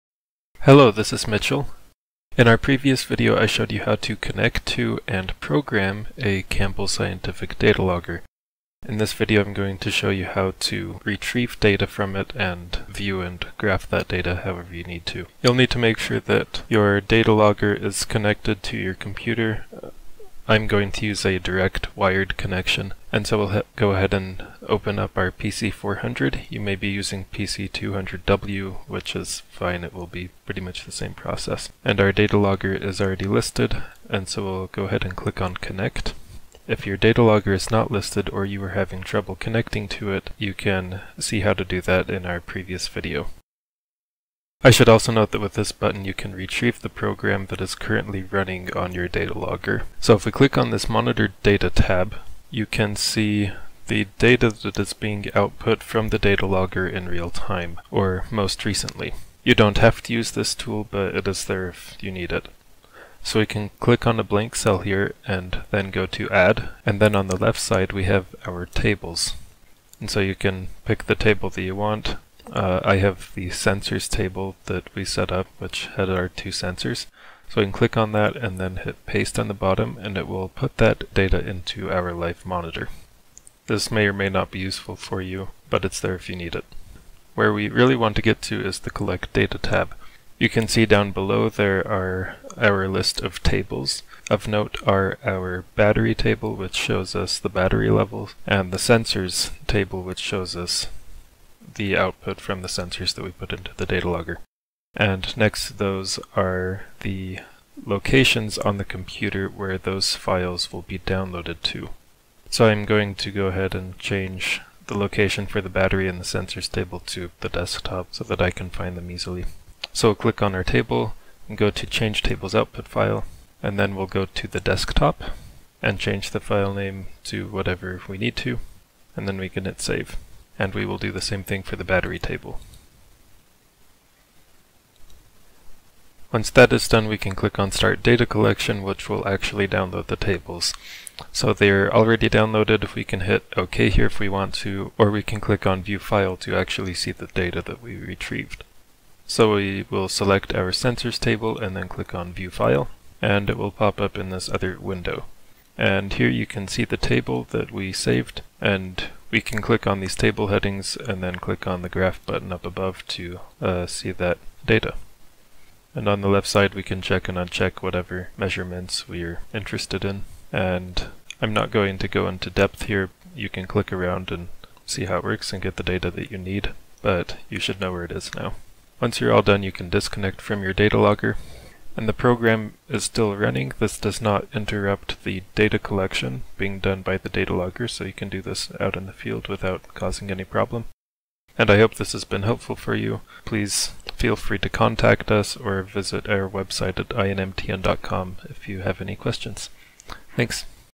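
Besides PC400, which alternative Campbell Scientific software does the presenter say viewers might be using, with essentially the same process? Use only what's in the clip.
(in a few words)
PC200W.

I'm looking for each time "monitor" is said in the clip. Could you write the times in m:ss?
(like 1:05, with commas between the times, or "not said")
0:50, 1:22.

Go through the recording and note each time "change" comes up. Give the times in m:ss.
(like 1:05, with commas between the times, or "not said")
1:53, 2:01, 2:05.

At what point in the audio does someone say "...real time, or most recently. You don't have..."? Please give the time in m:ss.
0:57.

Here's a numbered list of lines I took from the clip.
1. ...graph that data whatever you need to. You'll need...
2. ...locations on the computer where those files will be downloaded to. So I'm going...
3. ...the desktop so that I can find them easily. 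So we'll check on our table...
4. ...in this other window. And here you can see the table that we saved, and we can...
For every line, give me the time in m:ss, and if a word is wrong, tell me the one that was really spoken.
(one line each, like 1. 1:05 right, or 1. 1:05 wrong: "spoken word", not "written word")
1. 0:13 wrong: "however", not "whatever"
2. 1:47 right
3. 1:57 wrong: "click", not "check"
4. 2:34 right.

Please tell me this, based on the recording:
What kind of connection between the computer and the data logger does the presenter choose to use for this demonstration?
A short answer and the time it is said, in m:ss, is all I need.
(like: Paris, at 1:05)
direct wired connection, at 0:21.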